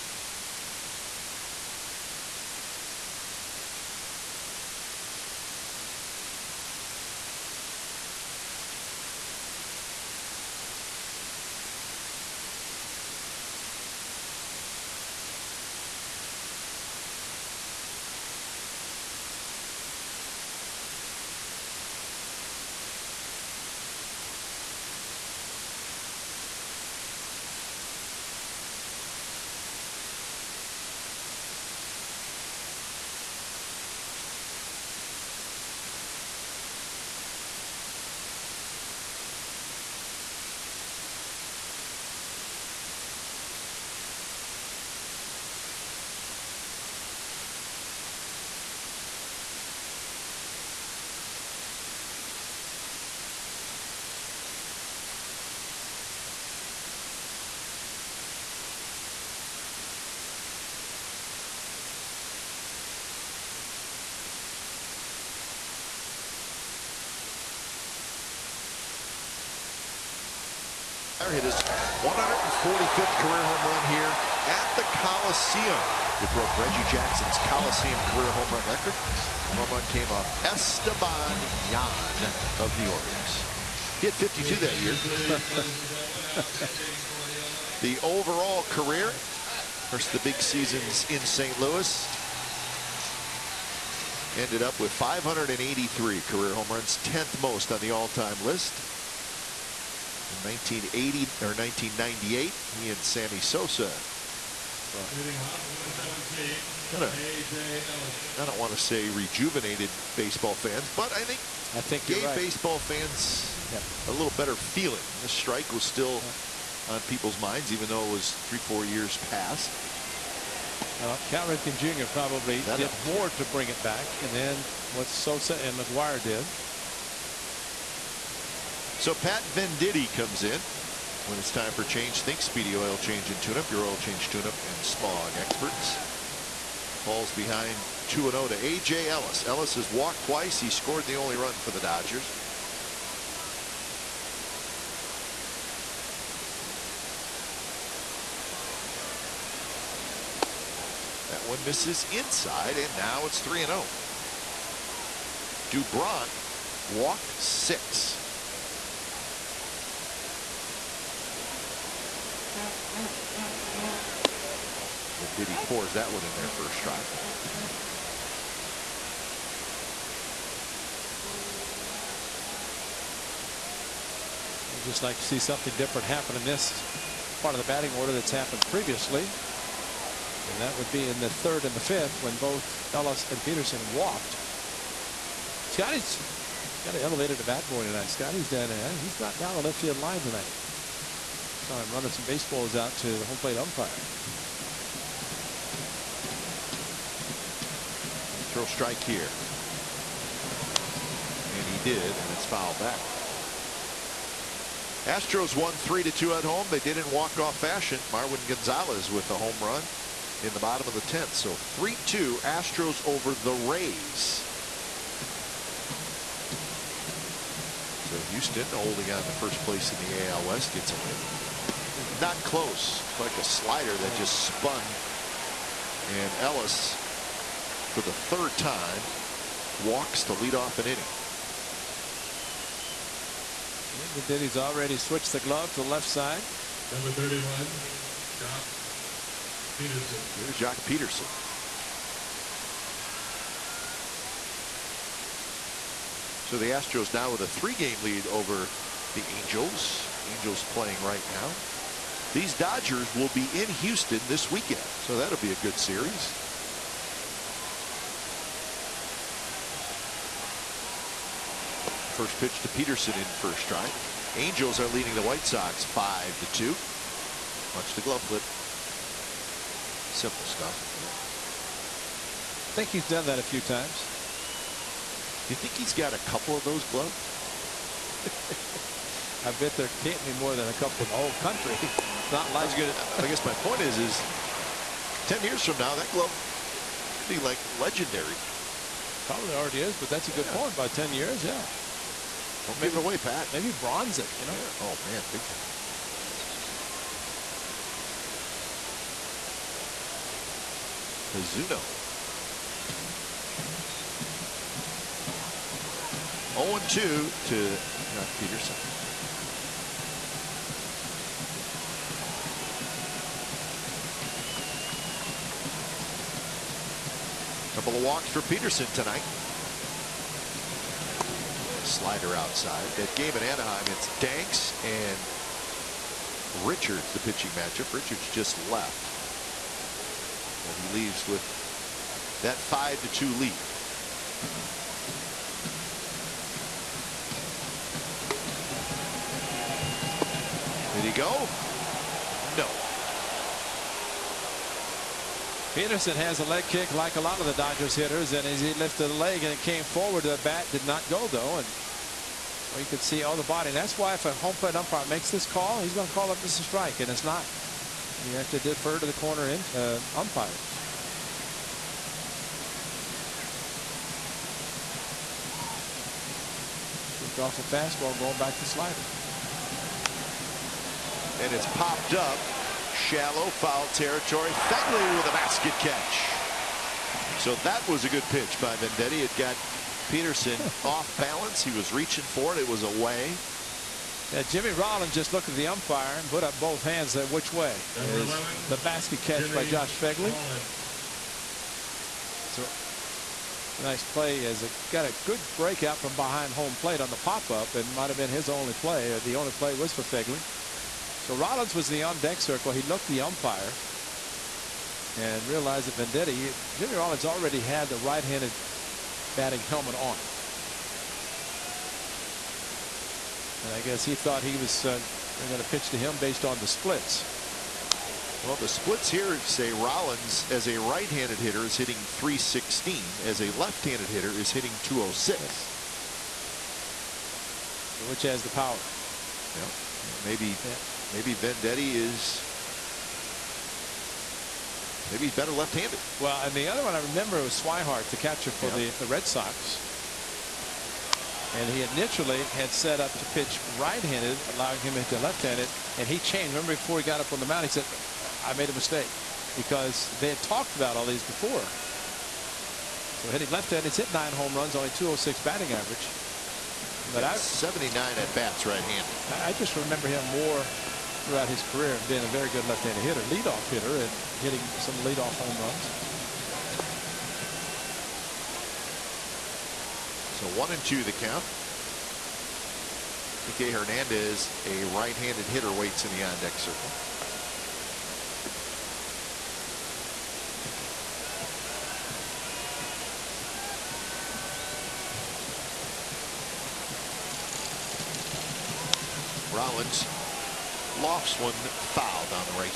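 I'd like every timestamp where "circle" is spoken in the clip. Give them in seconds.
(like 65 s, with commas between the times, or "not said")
402 s, 476 s.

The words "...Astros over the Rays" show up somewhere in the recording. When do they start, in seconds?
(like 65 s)
212 s.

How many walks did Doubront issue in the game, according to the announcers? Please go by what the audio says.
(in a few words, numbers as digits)
6.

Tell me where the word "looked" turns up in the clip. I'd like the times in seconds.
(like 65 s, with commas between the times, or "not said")
385 s, 402 s.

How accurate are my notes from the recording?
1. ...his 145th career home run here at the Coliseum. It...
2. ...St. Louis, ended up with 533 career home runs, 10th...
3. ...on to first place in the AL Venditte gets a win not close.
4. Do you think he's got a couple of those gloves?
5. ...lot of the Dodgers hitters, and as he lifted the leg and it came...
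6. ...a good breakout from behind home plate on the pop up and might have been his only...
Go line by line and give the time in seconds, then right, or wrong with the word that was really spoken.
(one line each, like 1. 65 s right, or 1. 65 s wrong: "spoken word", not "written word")
1. 71 s right
2. 91 s wrong: "583", not "533"
3. 219 s wrong: "West", not "Venditte"
4. 275 s right
5. 347 s right
6. 395 s right.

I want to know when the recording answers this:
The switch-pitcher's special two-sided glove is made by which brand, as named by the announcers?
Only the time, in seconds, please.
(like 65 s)
301 s.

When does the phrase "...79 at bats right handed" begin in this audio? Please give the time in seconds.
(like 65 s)
457 s.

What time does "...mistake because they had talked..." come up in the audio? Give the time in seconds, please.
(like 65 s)
448 s.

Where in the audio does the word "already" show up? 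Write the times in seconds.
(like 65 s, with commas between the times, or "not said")
234 s, 289 s, 407 s.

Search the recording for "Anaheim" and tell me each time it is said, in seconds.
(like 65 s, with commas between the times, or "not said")
323 s.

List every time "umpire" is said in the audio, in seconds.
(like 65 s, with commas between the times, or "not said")
193 s, 354 s, 360 s, 385 s, 403 s.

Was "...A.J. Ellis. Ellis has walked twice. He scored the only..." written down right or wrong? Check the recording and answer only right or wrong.
right.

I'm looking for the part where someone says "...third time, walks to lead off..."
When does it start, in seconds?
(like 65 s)
228 s.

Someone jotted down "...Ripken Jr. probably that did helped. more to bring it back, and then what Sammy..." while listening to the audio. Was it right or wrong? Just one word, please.
wrong.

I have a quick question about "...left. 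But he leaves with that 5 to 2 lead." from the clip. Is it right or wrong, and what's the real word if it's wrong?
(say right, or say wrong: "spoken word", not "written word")
right.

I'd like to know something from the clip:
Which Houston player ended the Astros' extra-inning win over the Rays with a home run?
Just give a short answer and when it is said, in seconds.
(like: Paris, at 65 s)
Marwin Gonzalez, at 208 s.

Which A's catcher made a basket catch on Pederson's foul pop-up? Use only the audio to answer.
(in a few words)
Josh Phegley.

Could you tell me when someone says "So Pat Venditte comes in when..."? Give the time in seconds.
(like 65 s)
128 s.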